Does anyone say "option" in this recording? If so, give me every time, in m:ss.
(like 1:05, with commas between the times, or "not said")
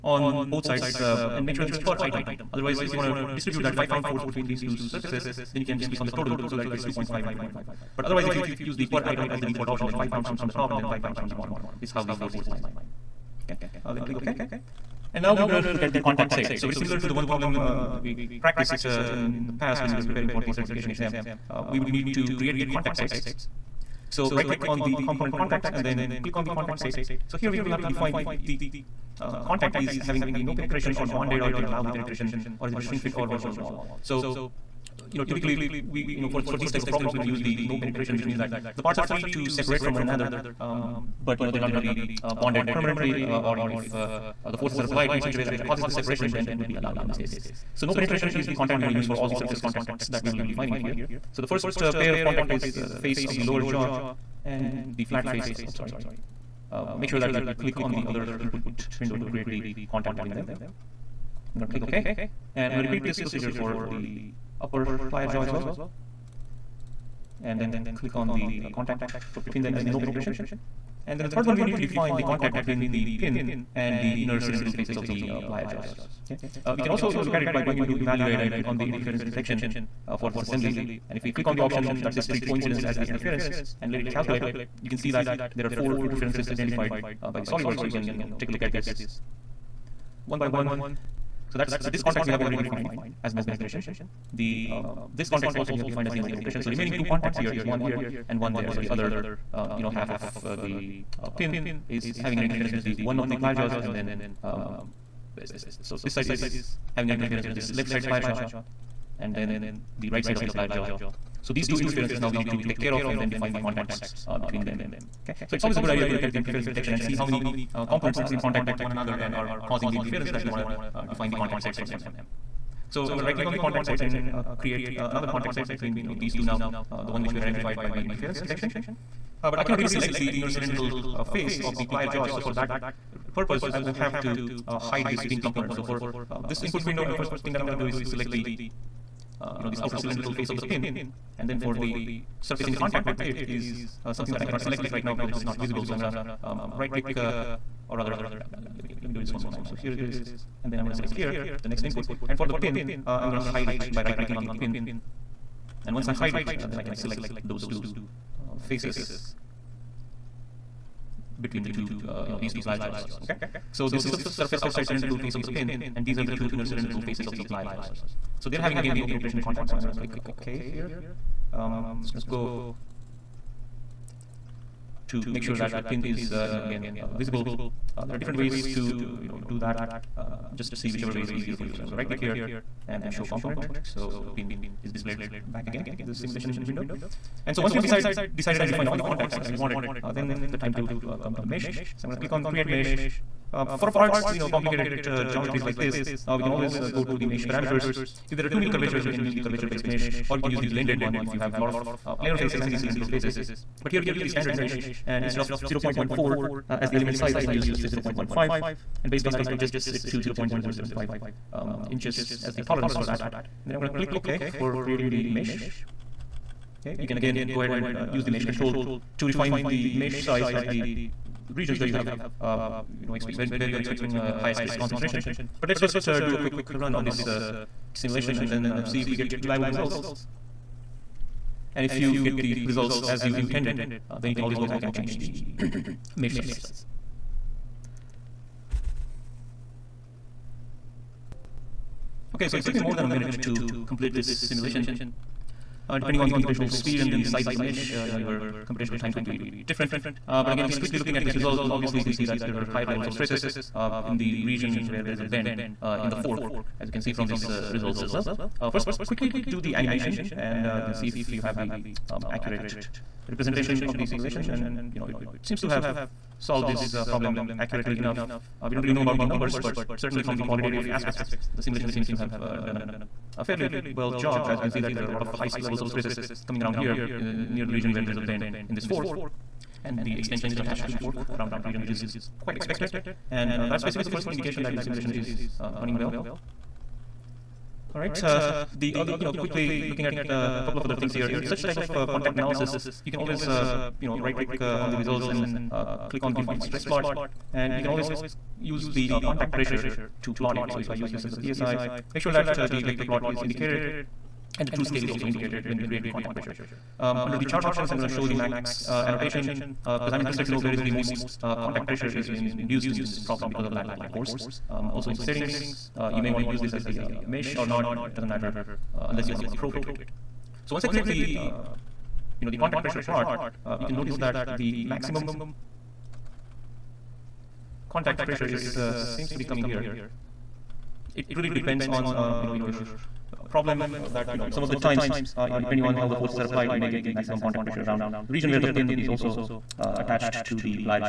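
0:09, 1:21, 5:07.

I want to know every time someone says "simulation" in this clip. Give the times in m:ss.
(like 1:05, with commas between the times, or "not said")
3:06, 3:47, 4:04, 4:24, 4:31, 4:44.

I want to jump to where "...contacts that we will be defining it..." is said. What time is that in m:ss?
0:49.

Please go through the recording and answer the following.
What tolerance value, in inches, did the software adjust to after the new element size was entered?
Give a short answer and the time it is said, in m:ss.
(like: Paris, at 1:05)
0.0075, at 3:30.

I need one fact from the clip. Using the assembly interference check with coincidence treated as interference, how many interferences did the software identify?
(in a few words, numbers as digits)
4.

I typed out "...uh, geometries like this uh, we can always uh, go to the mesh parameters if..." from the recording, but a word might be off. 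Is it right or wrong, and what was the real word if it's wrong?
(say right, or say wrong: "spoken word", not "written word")
right.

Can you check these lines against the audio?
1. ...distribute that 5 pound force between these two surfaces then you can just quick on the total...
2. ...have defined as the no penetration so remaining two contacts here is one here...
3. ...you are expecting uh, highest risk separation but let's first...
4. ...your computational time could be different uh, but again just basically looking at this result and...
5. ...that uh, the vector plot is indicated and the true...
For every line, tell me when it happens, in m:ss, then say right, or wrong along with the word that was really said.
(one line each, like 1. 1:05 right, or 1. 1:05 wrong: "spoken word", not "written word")
1. 0:03 wrong: "click", not "quick"
2. 1:35 right
3. 3:43 wrong: "concentration", not "separation"
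4. 4:08 wrong: "quickly", not "basically"
5. 5:02 right.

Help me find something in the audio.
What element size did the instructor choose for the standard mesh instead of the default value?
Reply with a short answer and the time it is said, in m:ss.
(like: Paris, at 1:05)
0.15, at 3:27.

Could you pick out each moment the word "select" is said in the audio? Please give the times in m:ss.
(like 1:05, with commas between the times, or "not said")
2:09, 2:18, 2:24, 2:30, 2:36.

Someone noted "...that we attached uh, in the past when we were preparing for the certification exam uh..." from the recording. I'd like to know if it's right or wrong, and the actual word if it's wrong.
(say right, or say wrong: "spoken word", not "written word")
wrong: "practiced", not "attached".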